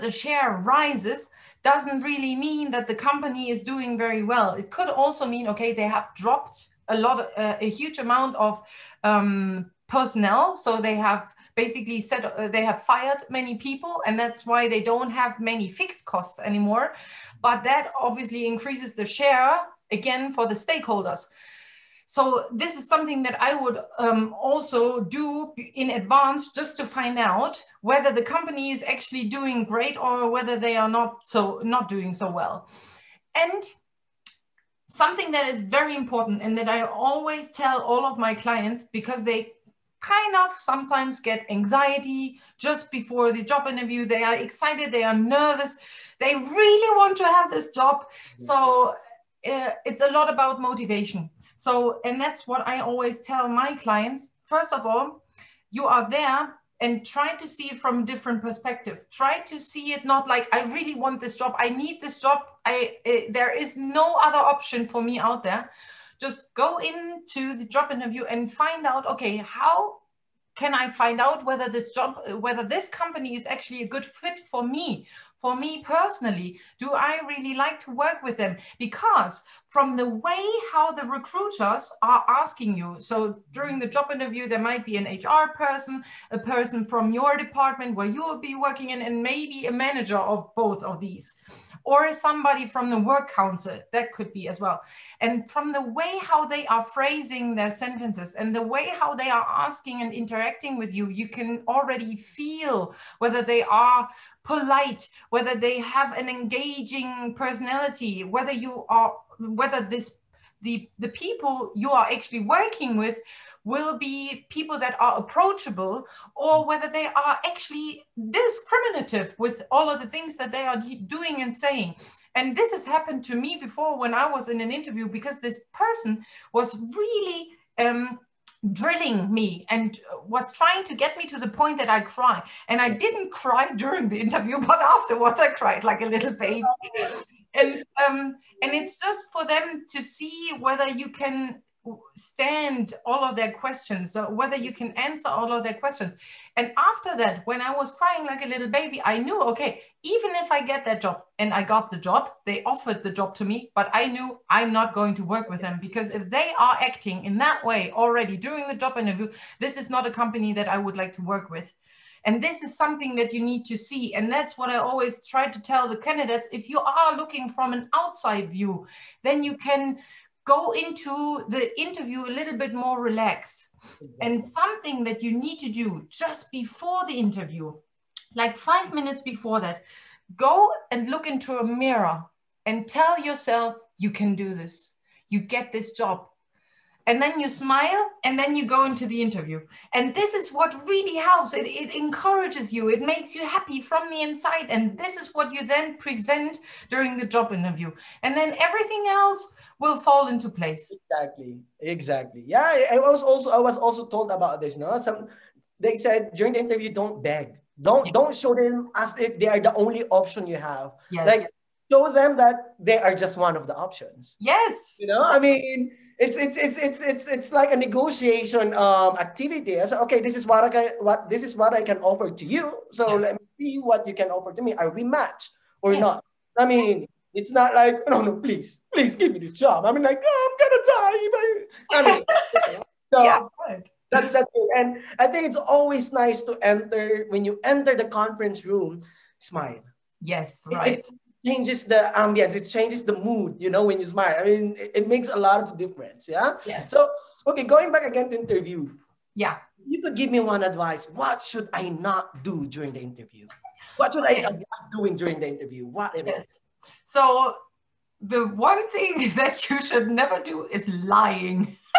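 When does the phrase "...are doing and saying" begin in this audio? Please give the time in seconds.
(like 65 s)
120 s.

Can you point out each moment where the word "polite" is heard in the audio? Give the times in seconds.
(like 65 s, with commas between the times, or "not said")
104 s.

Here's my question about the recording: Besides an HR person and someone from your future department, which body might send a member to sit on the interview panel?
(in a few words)
work council.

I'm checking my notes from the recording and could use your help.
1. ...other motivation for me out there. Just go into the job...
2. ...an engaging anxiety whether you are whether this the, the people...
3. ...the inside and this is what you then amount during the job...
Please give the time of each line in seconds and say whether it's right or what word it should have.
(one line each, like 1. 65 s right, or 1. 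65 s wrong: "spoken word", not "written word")
1. 64 s wrong: "option", not "motivation"
2. 106 s wrong: "personality", not "anxiety"
3. 194 s wrong: "present", not "amount".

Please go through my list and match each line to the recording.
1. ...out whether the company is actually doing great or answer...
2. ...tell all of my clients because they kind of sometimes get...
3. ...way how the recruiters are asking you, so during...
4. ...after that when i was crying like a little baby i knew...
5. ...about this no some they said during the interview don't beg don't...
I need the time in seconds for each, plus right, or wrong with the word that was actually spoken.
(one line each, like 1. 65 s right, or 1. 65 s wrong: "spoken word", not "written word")
1. 27 s wrong: "whether", not "answer"
2. 37 s right
3. 80 s right
4. 146 s right
5. 204 s right.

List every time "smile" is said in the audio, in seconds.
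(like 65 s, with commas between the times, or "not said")
187 s, 239 s, 244 s.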